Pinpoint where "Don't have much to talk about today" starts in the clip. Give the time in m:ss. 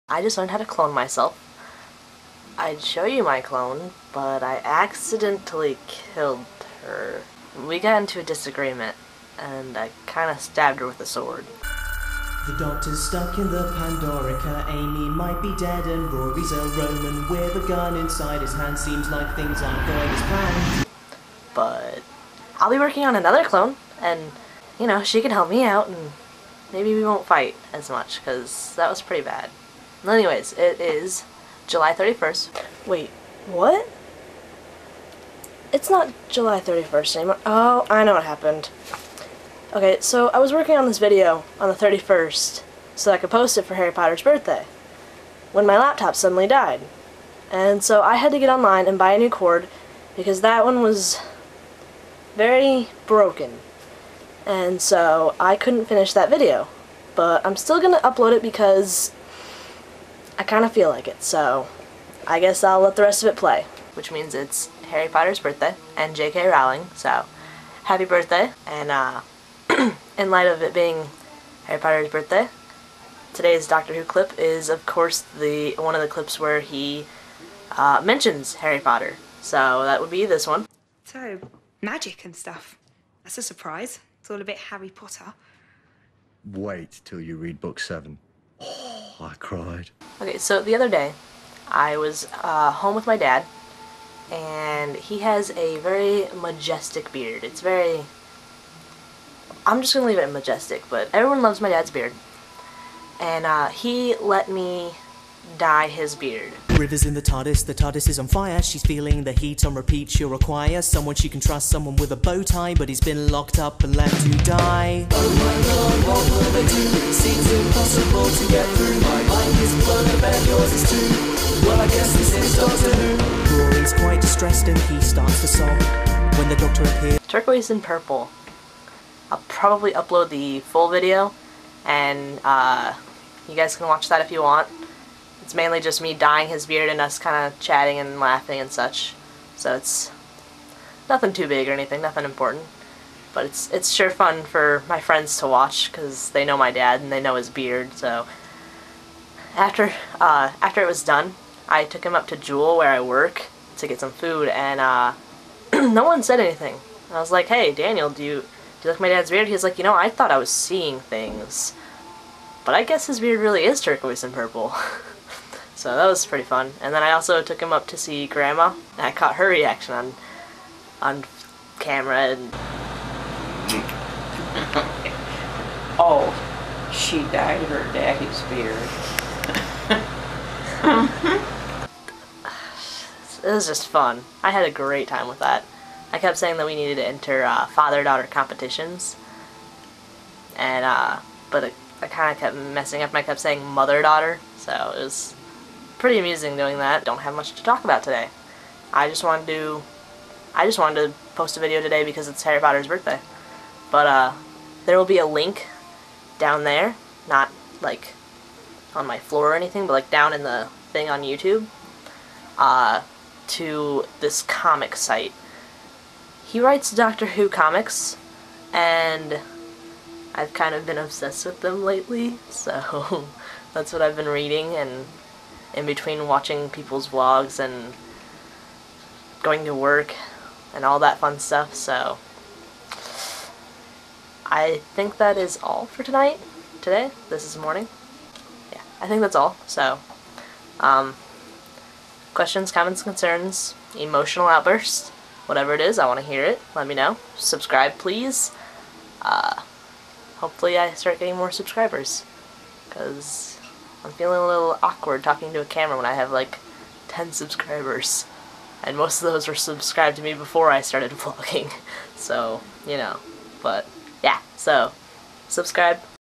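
3:17.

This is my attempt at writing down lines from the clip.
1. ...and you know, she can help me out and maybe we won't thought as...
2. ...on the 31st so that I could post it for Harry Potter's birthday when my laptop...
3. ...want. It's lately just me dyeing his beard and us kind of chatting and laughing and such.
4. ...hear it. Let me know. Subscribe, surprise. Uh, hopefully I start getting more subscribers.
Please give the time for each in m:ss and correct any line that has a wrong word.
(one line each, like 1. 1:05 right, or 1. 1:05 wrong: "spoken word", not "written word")
1. 0:24 wrong: "fight", not "thought"
2. 0:41 right
3. 2:14 wrong: "mainly", not "lately"
4. 4:06 wrong: "please", not "surprise".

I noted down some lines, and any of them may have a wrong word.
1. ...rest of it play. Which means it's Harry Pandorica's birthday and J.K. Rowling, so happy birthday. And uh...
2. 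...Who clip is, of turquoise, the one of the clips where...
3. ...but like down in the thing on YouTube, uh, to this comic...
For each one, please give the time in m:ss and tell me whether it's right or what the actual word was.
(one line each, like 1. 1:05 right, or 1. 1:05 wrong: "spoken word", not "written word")
1. 1:03 wrong: "Potter", not "Pandorica"
2. 1:13 wrong: "course", not "turquoise"
3. 3:29 right.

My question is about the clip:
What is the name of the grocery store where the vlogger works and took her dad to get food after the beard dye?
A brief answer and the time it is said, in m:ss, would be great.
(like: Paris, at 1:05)
Jewel, at 2:32.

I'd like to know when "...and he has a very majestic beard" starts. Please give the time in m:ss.
1:34.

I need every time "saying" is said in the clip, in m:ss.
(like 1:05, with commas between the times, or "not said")
3:06, 3:13.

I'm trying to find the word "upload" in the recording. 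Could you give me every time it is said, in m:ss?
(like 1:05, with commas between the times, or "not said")
0:58, 2:09.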